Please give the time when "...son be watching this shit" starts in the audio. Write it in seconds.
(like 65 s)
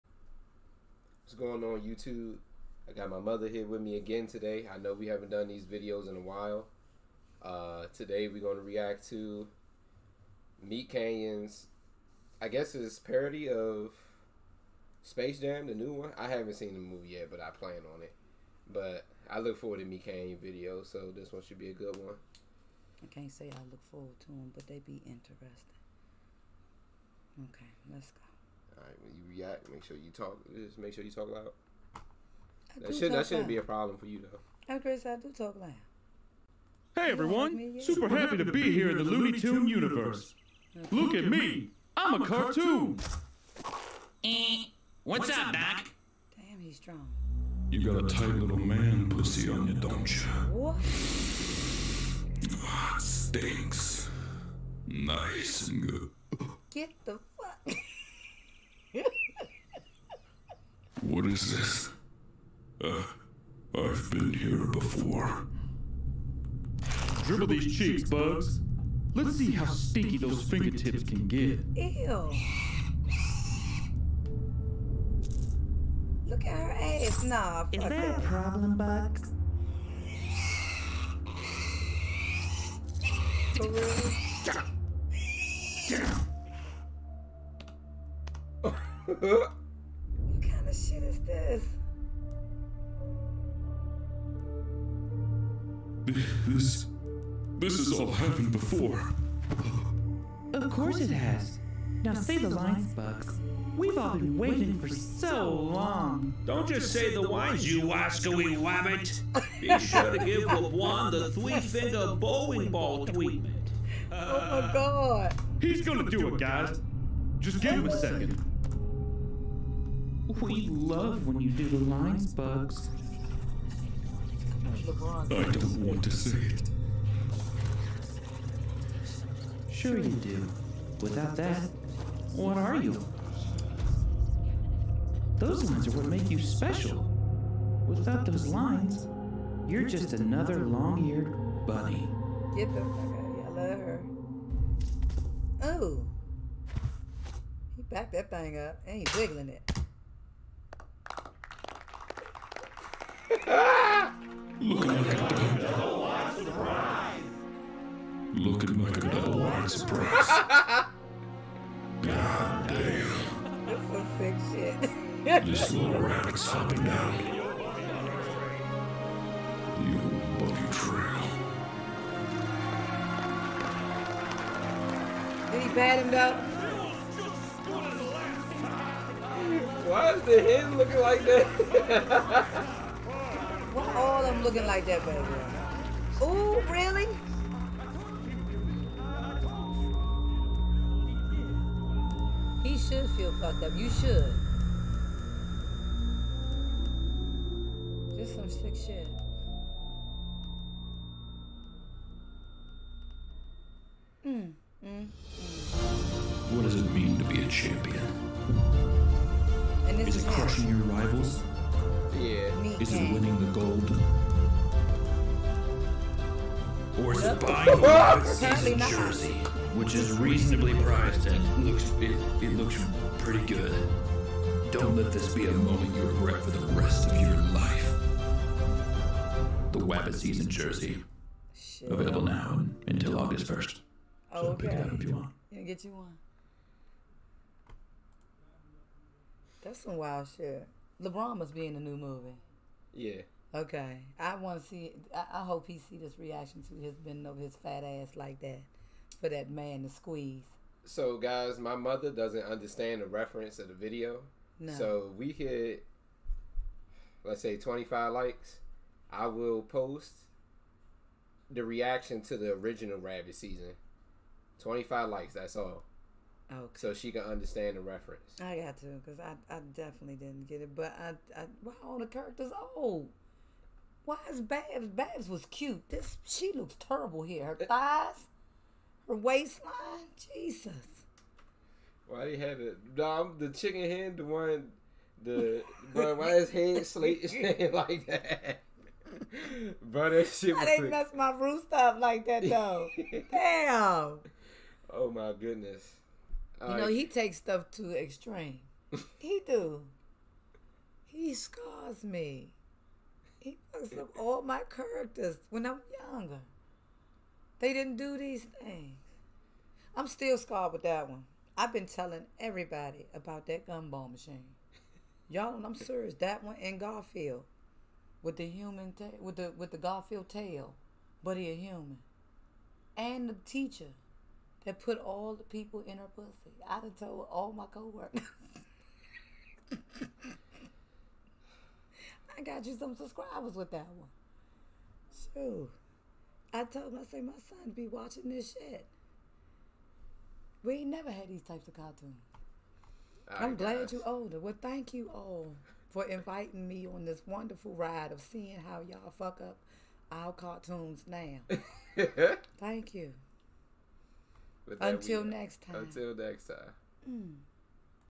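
337 s.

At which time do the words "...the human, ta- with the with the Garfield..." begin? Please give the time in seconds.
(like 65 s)
318 s.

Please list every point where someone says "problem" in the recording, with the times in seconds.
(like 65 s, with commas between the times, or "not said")
33 s, 78 s.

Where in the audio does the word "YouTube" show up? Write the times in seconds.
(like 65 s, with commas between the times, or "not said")
1 s.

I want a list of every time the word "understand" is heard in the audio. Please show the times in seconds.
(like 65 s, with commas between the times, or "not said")
252 s, 267 s.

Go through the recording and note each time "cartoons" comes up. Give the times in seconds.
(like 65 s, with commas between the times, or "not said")
42 s, 341 s, 350 s.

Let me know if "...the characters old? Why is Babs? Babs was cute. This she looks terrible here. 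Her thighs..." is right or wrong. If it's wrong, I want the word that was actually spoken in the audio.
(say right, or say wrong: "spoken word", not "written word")
right.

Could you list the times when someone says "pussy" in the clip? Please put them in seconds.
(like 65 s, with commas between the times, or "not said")
49 s, 326 s.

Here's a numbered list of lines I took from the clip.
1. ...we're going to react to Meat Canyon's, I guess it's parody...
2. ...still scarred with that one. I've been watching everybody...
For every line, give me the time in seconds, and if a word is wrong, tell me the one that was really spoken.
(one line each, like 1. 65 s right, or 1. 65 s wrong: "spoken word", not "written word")
1. 8 s right
2. 310 s wrong: "telling", not "watching".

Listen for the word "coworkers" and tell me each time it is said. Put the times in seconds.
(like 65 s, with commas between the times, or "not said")
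327 s.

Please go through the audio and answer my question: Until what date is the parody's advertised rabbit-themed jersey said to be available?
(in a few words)
August 1st.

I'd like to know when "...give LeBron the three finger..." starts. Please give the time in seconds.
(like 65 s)
110 s.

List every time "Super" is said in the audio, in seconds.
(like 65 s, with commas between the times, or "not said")
37 s.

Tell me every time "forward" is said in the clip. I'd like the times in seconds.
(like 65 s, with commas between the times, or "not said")
19 s, 23 s.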